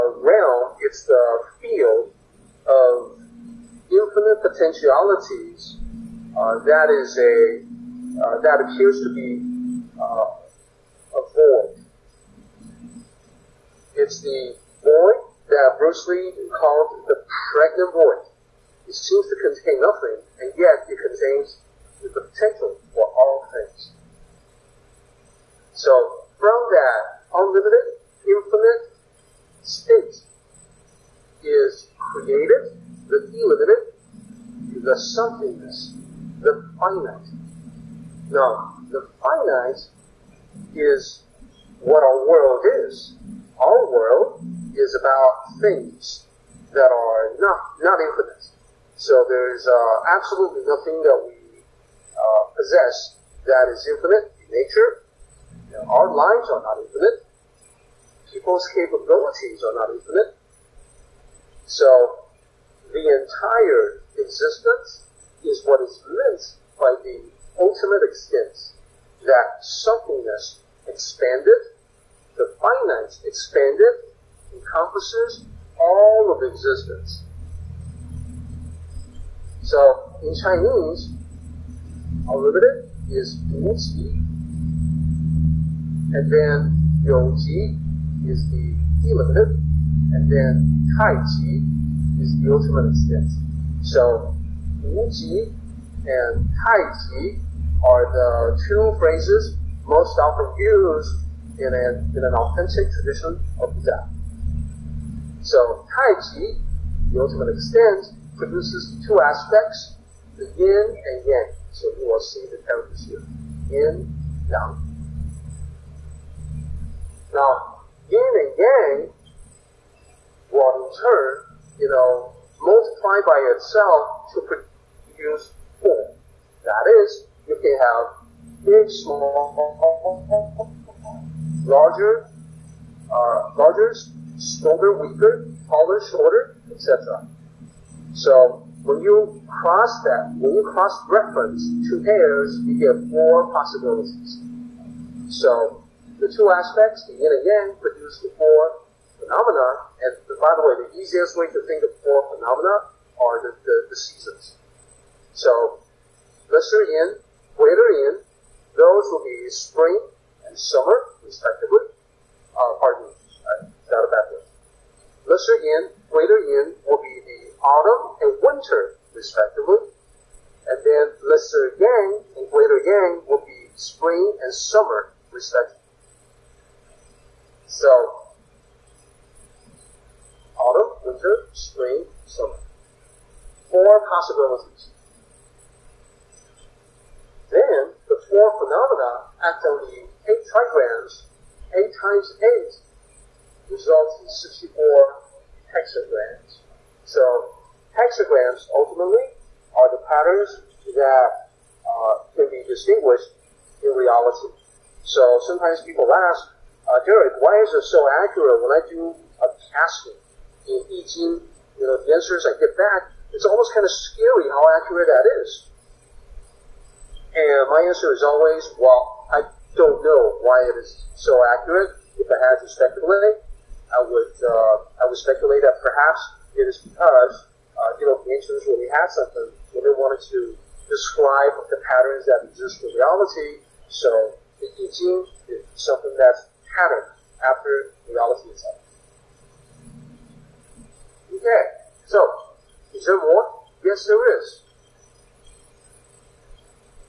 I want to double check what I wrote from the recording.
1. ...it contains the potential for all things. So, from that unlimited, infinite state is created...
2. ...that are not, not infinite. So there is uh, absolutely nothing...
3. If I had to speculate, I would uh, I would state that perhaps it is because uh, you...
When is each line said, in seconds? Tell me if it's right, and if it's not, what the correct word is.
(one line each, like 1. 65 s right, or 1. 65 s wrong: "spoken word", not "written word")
1. 20 s right
2. 46 s right
3. 222 s wrong: "speculate", not "state".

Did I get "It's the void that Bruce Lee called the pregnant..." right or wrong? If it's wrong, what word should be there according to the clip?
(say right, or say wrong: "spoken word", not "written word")
right.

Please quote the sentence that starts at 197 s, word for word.
So hexagrams ultimately are the patterns that uh, can be distinguished in reality.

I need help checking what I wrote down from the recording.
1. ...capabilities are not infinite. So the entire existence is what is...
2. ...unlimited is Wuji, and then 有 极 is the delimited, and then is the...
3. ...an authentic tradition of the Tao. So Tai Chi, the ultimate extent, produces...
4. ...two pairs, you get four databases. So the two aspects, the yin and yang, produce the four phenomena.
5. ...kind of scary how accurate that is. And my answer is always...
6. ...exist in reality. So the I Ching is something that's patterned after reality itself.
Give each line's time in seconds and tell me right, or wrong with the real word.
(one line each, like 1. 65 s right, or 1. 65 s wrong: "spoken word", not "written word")
1. 58 s right
2. 82 s right
3. 102 s right
4. 141 s wrong: "possibilities", not "databases"
5. 213 s right
6. 232 s right.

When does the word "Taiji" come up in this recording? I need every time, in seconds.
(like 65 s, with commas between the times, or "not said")
96 s.